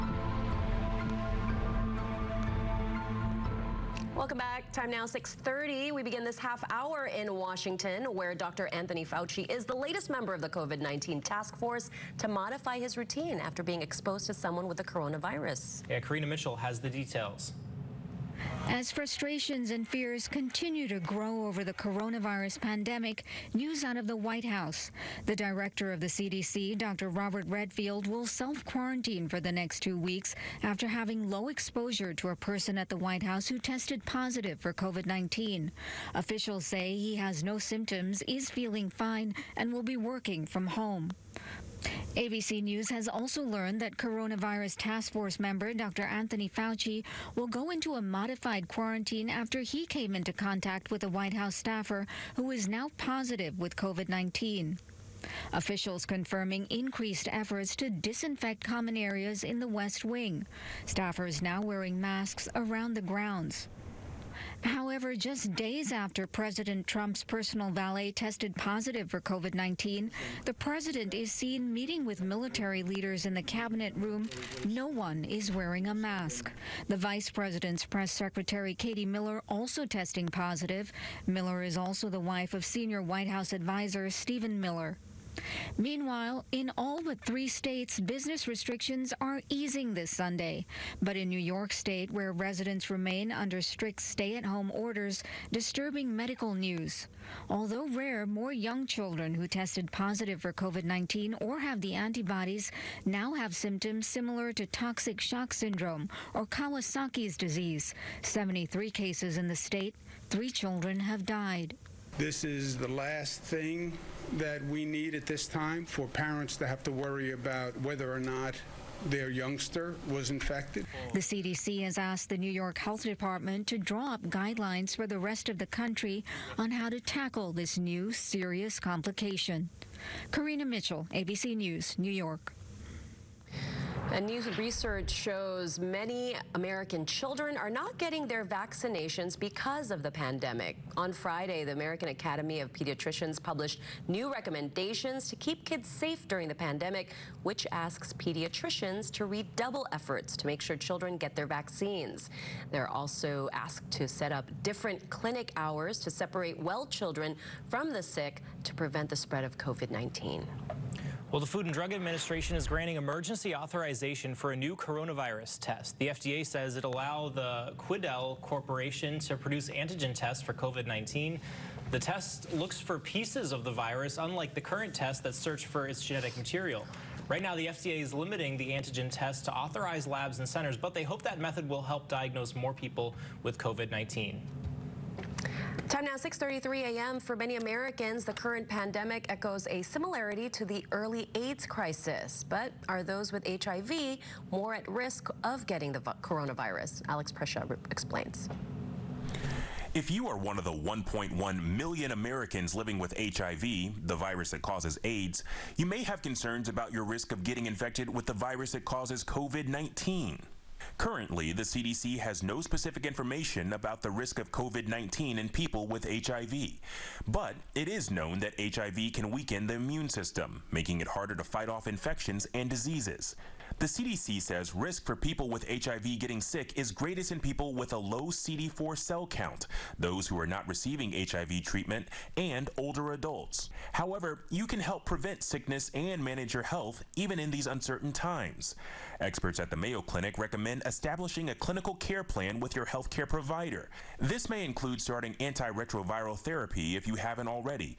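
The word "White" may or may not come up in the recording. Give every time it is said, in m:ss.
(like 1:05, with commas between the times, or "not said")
0:24, 0:32, 0:51, 1:23.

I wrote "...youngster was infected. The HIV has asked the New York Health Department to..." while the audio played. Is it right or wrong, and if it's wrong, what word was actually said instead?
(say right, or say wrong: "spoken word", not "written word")
wrong: "CDC", not "HIV".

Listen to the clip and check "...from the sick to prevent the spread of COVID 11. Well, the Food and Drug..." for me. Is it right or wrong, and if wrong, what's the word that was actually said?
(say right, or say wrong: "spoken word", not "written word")
wrong: "19", not "11".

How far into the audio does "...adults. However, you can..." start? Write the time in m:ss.
3:53.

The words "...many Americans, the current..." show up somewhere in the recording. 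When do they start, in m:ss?
3:07.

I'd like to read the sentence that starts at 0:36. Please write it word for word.
Officials say he has no symptoms, is feeling fine, and will be working from home.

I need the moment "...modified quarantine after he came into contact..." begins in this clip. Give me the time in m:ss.
0:48.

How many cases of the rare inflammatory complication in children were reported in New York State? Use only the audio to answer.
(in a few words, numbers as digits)
73.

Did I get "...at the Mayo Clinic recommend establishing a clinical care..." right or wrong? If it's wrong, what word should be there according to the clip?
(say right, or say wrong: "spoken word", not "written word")
right.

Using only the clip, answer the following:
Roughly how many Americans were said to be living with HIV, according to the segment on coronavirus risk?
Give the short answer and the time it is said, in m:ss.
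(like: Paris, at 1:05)
1.1 million, at 3:20.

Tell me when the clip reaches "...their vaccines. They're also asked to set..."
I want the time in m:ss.
2:31.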